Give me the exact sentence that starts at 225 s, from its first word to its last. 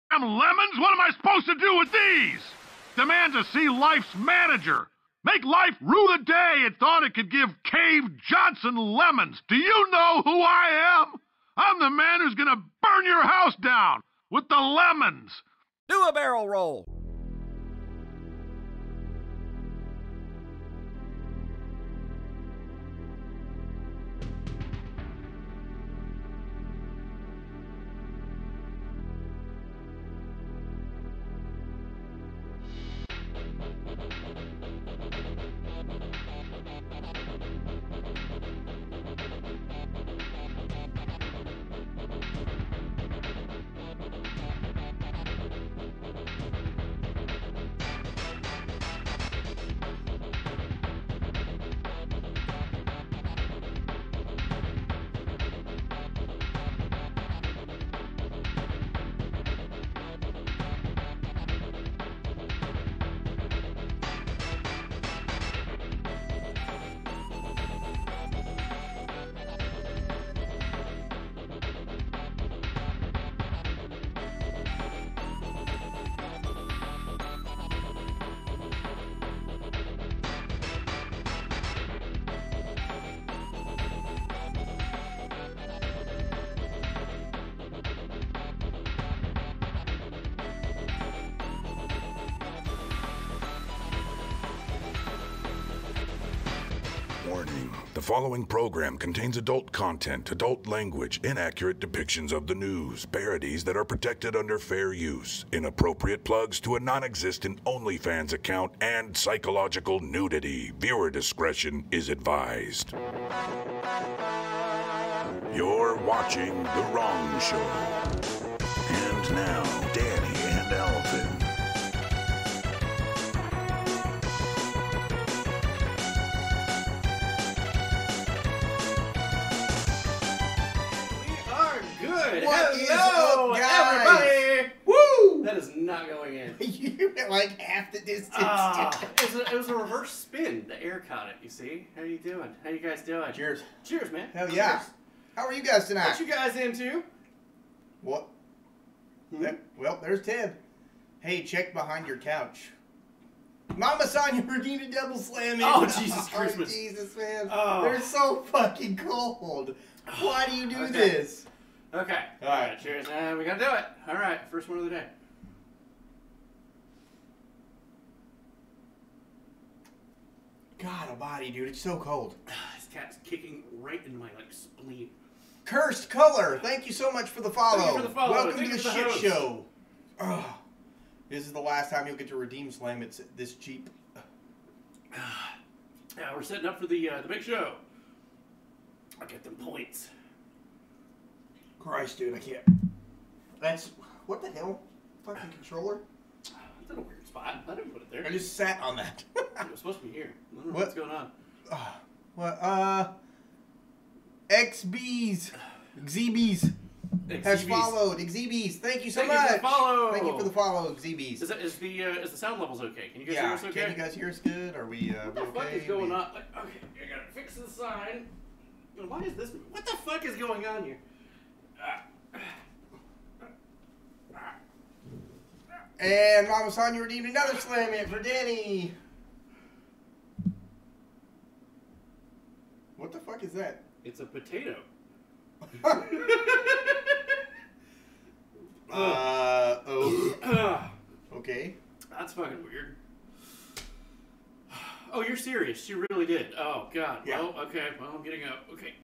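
And Ramos you redeemed another slam hit for Danny.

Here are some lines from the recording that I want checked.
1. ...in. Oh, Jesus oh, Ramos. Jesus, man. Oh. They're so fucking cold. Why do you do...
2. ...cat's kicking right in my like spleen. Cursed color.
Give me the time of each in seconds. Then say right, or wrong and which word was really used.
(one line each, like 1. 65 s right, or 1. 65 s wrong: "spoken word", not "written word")
1. 155 s wrong: "Christmas", not "Ramos"
2. 172 s right.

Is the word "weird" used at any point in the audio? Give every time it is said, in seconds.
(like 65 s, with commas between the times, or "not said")
197 s, 242 s.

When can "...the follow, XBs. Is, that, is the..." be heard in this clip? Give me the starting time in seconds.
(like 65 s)
210 s.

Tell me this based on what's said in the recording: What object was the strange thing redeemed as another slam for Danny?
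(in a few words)
A potato.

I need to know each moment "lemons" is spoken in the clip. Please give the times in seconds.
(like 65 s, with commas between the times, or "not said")
0 s, 8 s, 14 s.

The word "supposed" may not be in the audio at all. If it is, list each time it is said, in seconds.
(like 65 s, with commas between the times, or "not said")
1 s, 199 s.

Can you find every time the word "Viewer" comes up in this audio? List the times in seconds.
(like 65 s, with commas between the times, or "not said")
110 s.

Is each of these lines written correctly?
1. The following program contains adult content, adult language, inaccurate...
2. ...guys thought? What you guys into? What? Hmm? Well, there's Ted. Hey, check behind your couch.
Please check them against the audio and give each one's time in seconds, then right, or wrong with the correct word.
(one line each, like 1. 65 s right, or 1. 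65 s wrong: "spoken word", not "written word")
1. 97 s right
2. 145 s wrong: "tonight", not "thought".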